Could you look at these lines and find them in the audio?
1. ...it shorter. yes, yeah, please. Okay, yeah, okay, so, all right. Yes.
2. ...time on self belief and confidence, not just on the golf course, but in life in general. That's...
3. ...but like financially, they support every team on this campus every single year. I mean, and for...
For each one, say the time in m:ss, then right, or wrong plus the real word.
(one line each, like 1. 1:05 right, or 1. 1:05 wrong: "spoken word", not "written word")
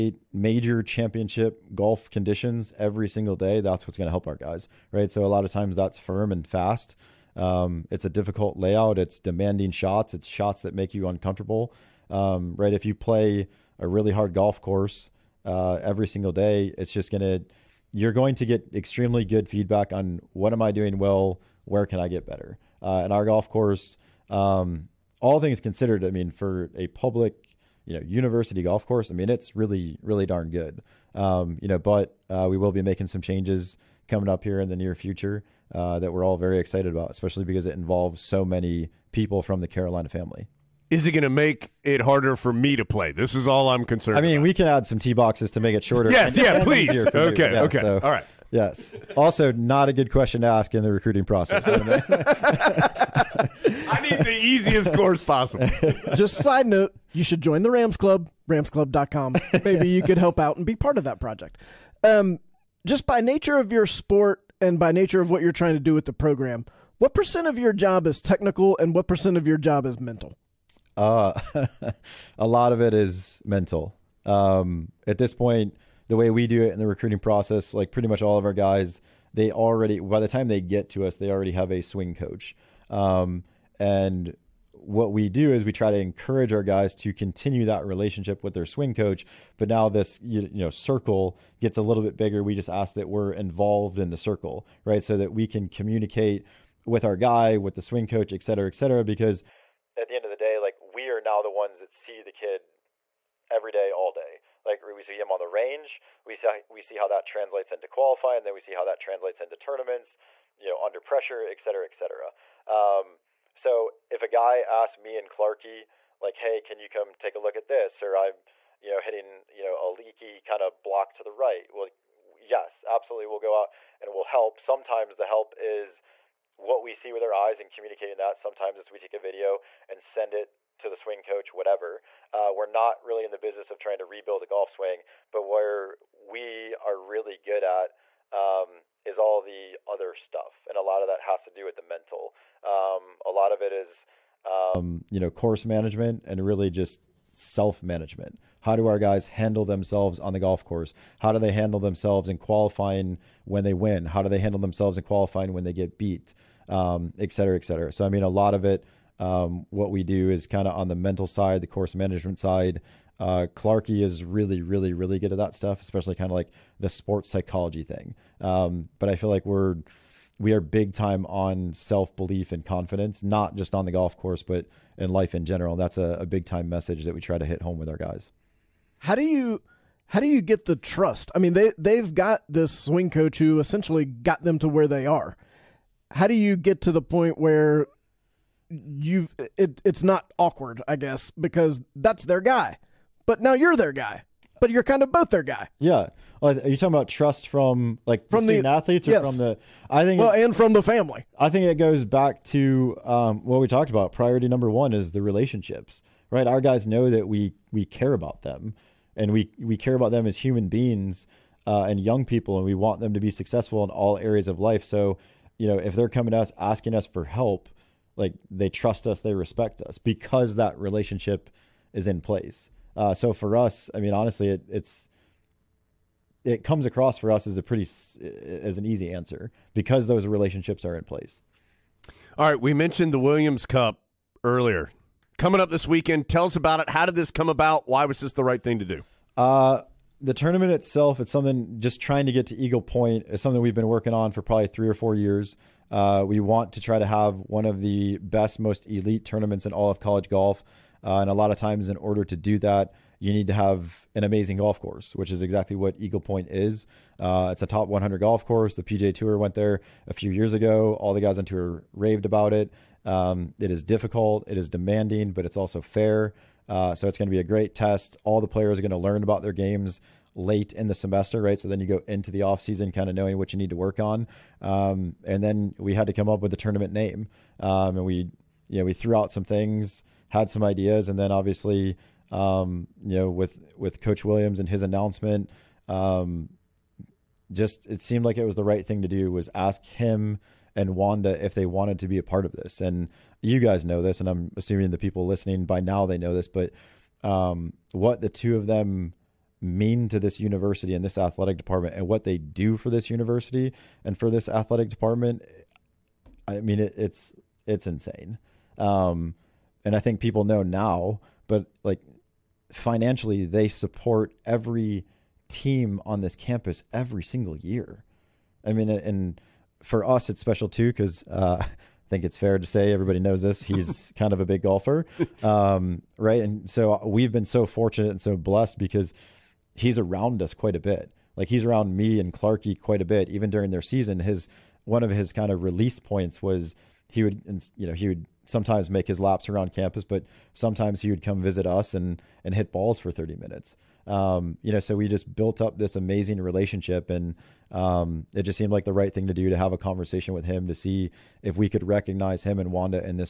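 1. 0:45 right
2. 2:50 right
3. 5:11 right.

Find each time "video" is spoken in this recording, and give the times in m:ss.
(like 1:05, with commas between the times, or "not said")
2:09.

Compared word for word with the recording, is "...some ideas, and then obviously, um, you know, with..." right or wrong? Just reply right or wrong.
right.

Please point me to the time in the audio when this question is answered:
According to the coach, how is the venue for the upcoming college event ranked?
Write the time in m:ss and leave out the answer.
4:17.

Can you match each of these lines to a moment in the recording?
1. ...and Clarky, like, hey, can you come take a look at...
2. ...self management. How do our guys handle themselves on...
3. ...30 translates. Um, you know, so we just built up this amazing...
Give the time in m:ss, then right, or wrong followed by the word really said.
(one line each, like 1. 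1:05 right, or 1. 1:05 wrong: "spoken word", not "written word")
1. 1:55 right
2. 2:27 right
3. 5:43 wrong: "minutes", not "translates".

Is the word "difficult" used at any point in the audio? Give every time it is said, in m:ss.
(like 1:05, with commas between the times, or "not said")
0:08, 4:23.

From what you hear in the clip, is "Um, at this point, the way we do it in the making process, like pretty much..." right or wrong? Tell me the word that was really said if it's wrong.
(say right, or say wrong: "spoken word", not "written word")
wrong: "recruiting", not "making".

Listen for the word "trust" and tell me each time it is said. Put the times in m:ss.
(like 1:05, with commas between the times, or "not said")
3:00, 3:17, 3:38.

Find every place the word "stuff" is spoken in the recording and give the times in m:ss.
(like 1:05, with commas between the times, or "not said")
2:20, 2:45.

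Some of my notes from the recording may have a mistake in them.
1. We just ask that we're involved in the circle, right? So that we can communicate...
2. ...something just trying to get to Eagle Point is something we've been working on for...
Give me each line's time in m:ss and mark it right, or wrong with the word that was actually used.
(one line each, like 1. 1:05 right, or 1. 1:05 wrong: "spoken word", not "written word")
1. 1:32 right
2. 4:01 right.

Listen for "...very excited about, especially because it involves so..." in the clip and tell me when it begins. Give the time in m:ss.
0:36.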